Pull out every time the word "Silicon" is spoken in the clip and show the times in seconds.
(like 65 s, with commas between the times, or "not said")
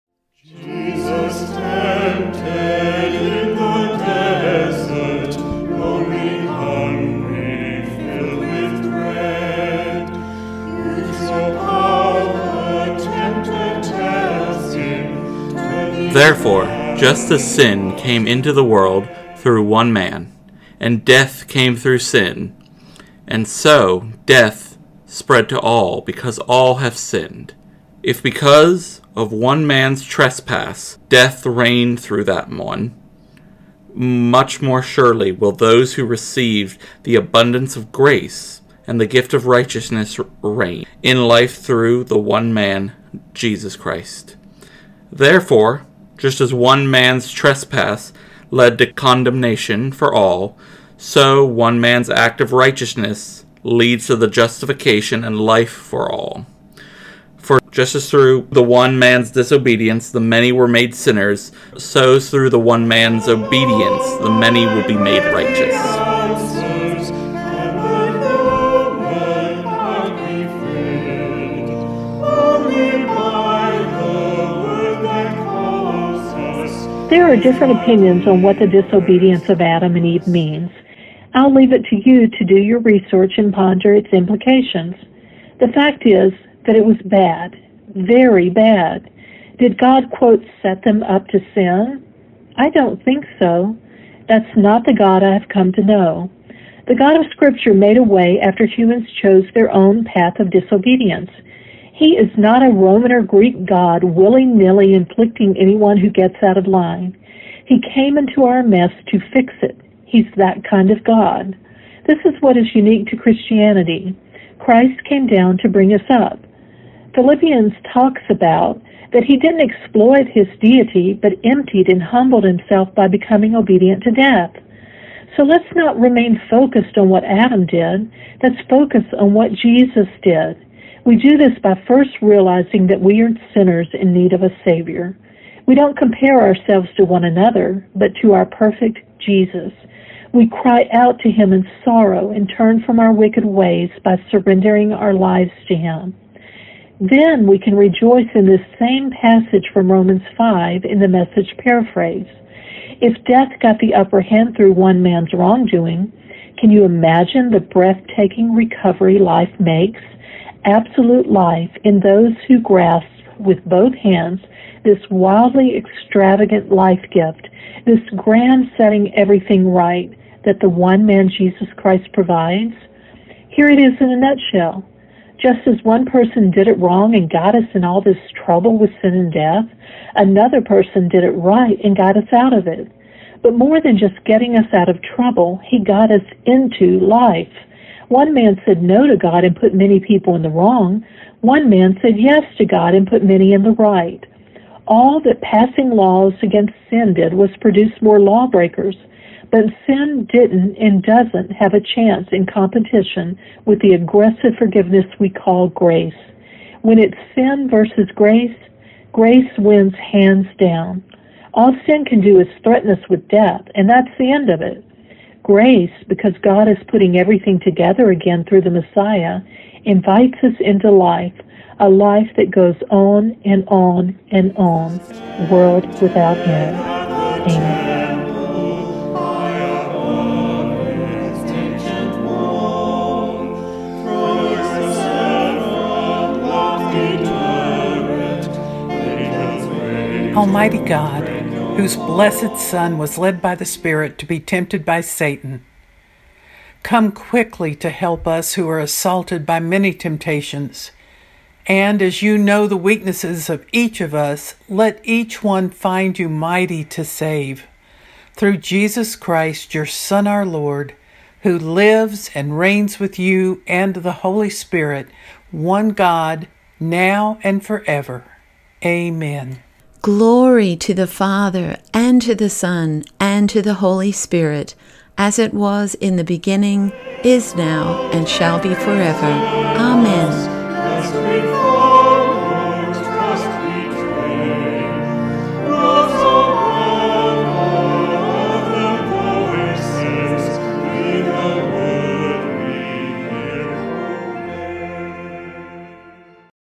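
not said.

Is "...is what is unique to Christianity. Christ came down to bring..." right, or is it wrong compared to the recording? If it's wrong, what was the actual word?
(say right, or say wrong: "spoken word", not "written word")
right.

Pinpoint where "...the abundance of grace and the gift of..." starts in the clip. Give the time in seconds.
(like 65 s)
37 s.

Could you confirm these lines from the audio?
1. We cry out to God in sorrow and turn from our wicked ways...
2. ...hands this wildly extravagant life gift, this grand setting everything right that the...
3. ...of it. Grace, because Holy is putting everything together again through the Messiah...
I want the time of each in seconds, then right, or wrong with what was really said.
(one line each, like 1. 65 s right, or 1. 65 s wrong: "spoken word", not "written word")
1. 140 s wrong: "Him", not "God"
2. 163 s right
3. 214 s wrong: "God", not "Holy".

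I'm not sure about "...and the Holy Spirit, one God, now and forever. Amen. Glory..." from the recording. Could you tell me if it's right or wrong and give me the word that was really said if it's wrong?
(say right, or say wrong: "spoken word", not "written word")
right.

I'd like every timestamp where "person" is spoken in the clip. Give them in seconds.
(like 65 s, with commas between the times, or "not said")
176 s, 180 s.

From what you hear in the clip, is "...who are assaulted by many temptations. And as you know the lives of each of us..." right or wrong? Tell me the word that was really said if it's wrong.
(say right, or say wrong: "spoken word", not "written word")
wrong: "weaknesses", not "lives".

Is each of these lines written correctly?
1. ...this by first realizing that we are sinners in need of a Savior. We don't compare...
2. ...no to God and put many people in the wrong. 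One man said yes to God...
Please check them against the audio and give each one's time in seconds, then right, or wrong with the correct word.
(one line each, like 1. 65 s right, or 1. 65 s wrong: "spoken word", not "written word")
1. 131 s right
2. 188 s right.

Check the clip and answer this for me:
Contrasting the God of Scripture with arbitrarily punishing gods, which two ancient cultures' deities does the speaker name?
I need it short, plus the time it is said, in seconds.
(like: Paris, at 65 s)
Roman or Greek, at 102 s.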